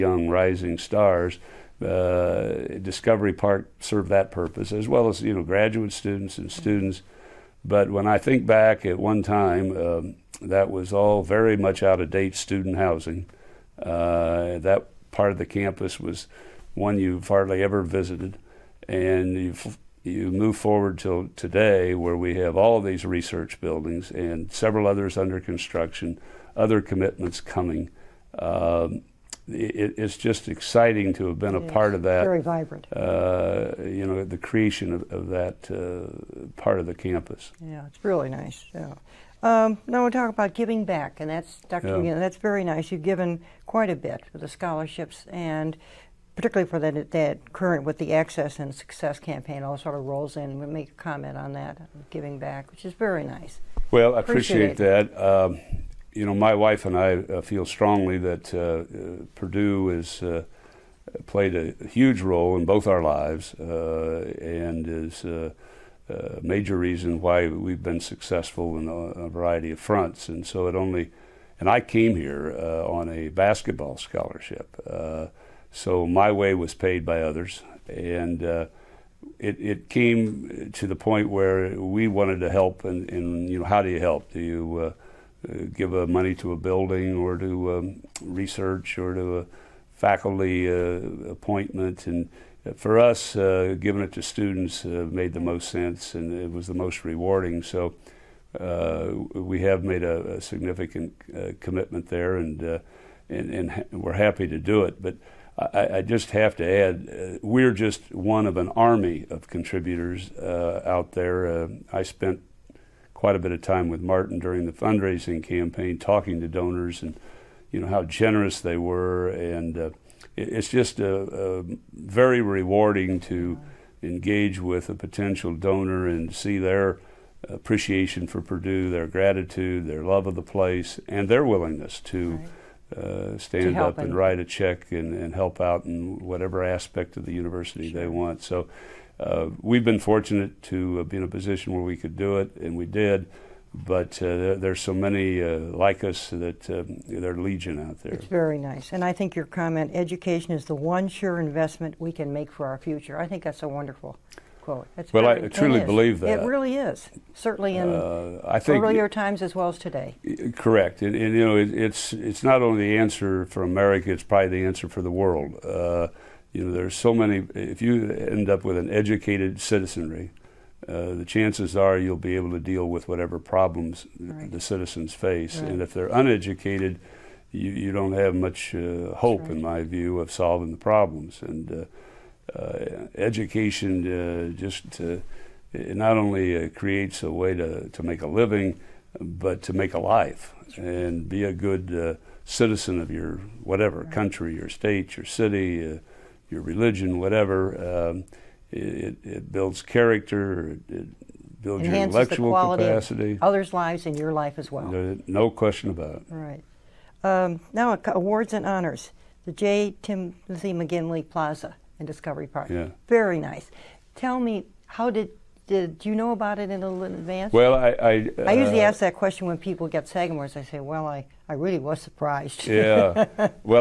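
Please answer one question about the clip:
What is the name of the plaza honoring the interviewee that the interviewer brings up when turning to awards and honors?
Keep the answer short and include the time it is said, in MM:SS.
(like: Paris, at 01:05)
J. Timothy McGinley Plaza, at 03:29.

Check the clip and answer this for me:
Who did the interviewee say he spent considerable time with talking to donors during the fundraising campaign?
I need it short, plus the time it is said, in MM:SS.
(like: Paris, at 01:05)
Martin, at 01:53.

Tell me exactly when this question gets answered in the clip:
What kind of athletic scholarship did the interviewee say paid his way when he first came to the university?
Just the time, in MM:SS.
01:13.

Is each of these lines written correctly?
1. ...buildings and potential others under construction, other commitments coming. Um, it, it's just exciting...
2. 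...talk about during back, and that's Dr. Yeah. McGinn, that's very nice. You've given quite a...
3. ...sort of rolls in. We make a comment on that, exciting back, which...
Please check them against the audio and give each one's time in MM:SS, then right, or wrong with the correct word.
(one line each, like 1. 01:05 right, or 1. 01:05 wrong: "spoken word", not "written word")
1. 00:23 wrong: "several", not "potential"
2. 00:40 wrong: "giving", not "during"
3. 00:49 wrong: "giving", not "exciting".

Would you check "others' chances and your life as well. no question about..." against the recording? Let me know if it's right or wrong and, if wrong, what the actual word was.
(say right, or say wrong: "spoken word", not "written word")
wrong: "lives", not "chances".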